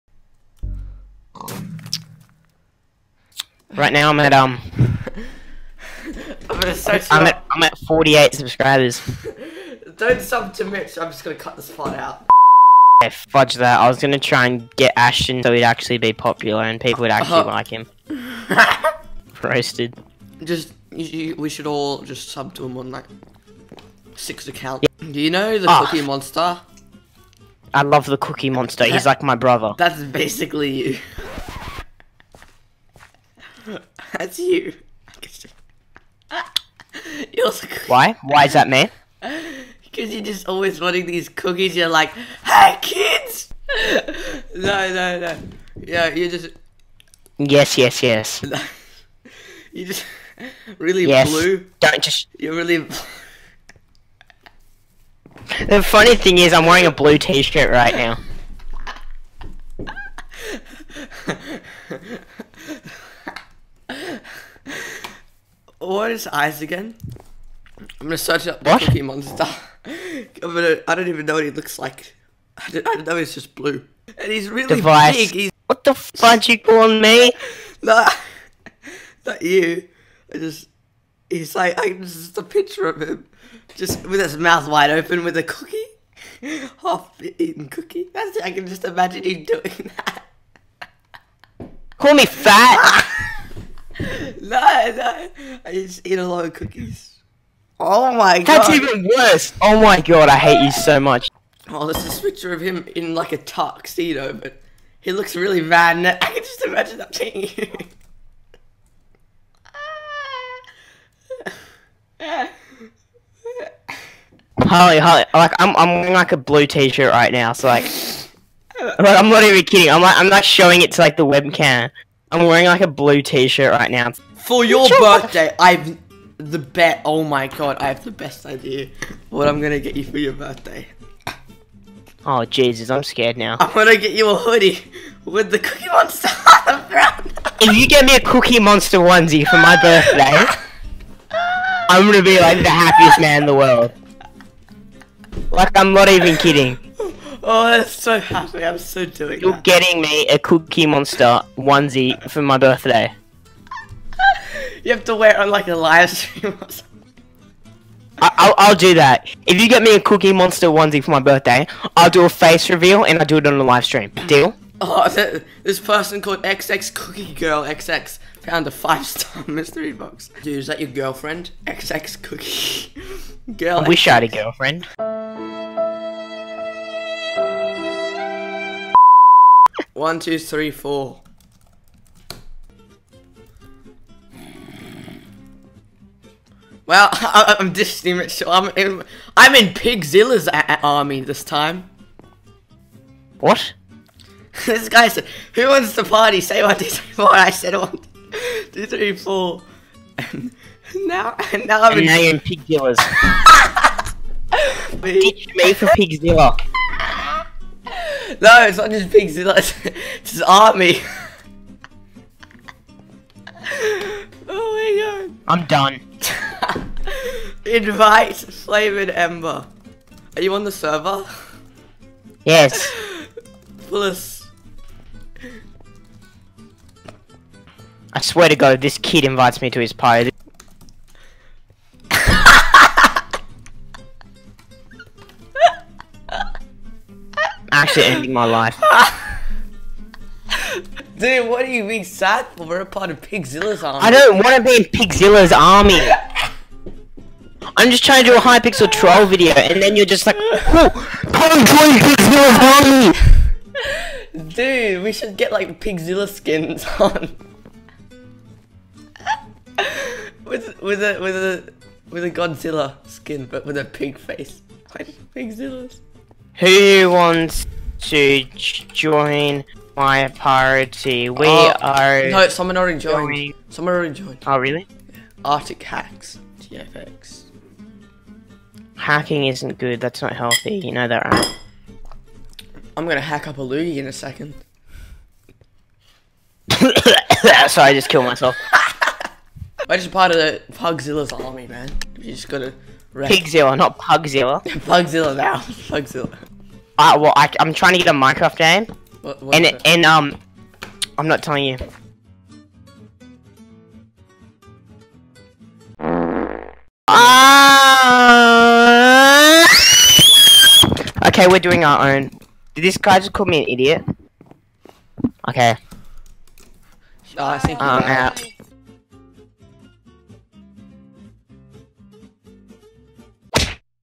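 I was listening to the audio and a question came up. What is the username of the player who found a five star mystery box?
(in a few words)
XX Cookie Girl XX.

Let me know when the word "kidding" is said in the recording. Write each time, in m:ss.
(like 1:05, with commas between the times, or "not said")
1:59, 2:26.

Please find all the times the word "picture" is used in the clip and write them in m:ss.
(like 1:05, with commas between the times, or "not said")
1:22, 1:42.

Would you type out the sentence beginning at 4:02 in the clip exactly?
We're a part of Pigzilla's army.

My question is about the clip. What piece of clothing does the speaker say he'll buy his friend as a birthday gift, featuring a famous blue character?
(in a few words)
A hoodie.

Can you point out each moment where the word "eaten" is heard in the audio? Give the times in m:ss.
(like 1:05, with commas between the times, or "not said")
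1:26.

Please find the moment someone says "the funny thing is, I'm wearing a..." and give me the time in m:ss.
0:55.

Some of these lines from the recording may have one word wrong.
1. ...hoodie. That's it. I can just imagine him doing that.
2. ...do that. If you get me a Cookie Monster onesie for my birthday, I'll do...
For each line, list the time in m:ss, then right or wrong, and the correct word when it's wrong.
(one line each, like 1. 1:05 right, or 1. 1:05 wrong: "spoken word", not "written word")
1. 1:27 wrong: "cookie", not "hoodie"
2. 2:38 right.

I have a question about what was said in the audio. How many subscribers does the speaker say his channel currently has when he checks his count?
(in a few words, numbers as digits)
48.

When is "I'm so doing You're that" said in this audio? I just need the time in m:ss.
2:28.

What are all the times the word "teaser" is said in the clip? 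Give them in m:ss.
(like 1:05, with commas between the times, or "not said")
not said.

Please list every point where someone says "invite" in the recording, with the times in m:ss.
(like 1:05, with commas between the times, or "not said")
3:37, 3:49.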